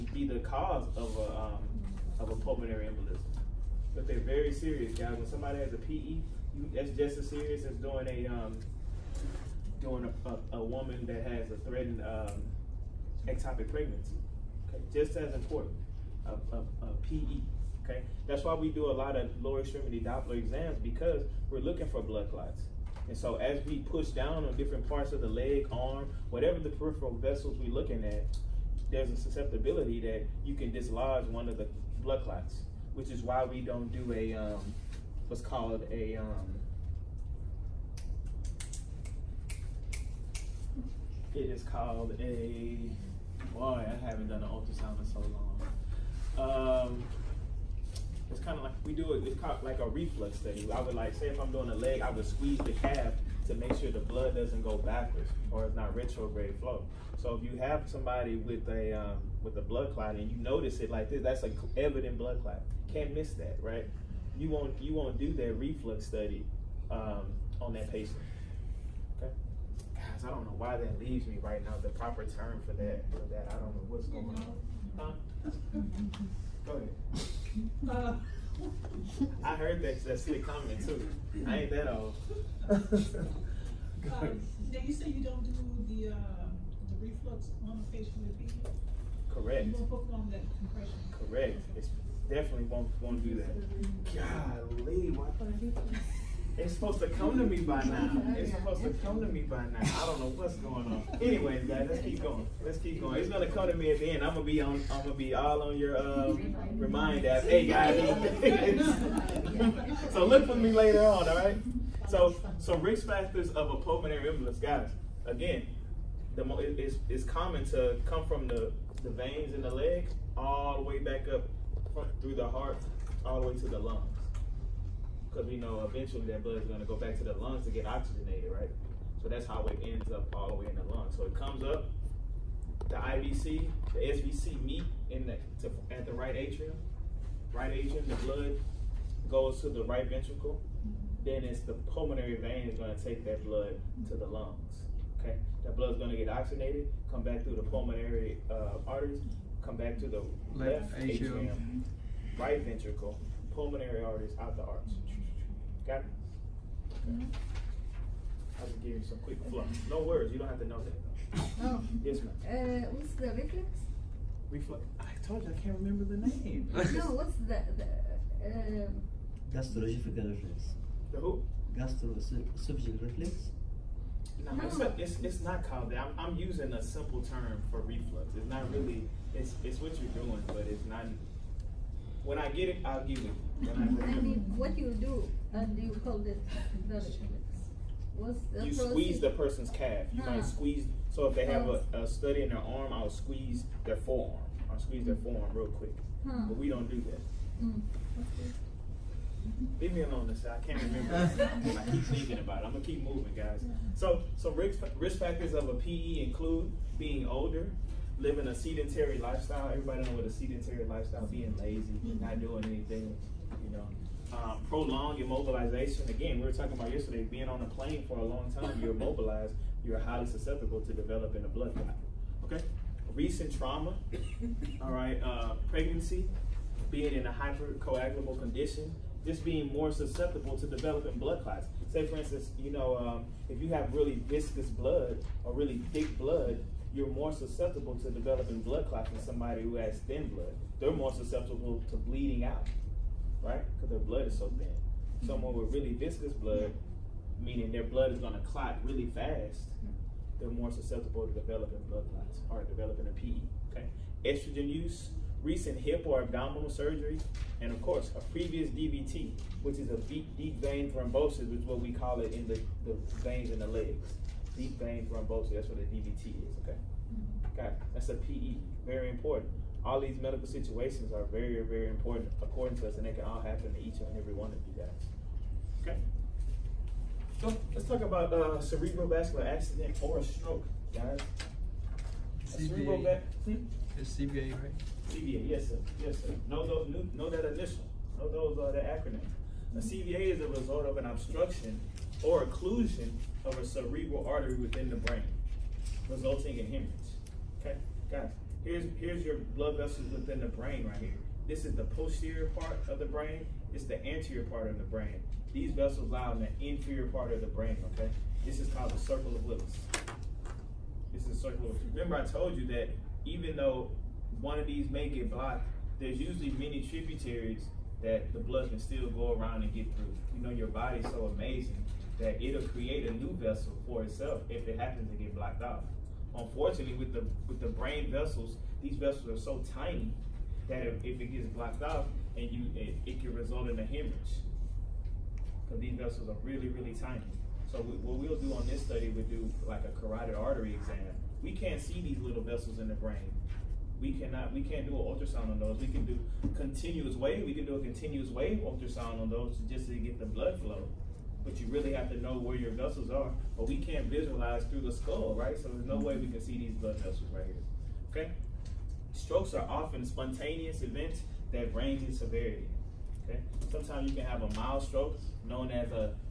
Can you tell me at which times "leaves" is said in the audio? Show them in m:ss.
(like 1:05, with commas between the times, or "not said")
1:10, 3:19.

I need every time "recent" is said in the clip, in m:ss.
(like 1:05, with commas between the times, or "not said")
3:43, 4:15.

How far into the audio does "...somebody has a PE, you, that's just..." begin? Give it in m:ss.
0:05.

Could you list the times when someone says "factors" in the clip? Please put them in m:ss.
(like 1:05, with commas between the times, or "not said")
1:53, 3:25.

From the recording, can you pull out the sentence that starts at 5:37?
So we, what we'll do on this study, we'll do like a carotid artery exam.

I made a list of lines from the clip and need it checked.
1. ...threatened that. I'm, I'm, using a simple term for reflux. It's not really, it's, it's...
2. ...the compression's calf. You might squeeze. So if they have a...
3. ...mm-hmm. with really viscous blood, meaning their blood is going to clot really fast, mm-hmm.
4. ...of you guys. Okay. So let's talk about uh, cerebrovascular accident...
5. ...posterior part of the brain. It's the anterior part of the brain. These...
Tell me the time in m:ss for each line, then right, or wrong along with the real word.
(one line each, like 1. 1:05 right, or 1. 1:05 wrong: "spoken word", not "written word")
1. 2:55 wrong: "called", not "threatened"
2. 3:09 wrong: "person", not "compression"
3. 4:05 right
4. 4:34 right
5. 5:01 right.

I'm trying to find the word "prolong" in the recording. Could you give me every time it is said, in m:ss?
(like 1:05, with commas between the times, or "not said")
3:34.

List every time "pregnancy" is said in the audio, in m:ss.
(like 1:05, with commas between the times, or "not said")
0:13, 3:45.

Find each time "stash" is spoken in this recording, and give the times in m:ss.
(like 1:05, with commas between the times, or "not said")
not said.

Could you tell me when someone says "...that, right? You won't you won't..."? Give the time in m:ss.
1:03.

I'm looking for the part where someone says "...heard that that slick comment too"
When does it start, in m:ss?
1:19.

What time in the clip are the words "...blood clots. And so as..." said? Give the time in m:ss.
0:22.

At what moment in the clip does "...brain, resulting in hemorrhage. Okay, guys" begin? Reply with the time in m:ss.
4:54.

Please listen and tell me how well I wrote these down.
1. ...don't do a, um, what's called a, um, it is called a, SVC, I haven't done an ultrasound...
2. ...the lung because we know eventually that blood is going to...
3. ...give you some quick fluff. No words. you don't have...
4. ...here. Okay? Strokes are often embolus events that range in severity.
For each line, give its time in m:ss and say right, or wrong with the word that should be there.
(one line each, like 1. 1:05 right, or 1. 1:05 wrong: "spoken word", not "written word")
1. 0:33 wrong: "Boy", not "SVC"
2. 2:03 right
3. 2:38 right
4. 5:57 wrong: "spontaneous", not "embolus".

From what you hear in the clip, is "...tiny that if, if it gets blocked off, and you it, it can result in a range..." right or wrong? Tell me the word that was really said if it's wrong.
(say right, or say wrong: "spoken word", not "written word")
wrong: "hemorrhage", not "range".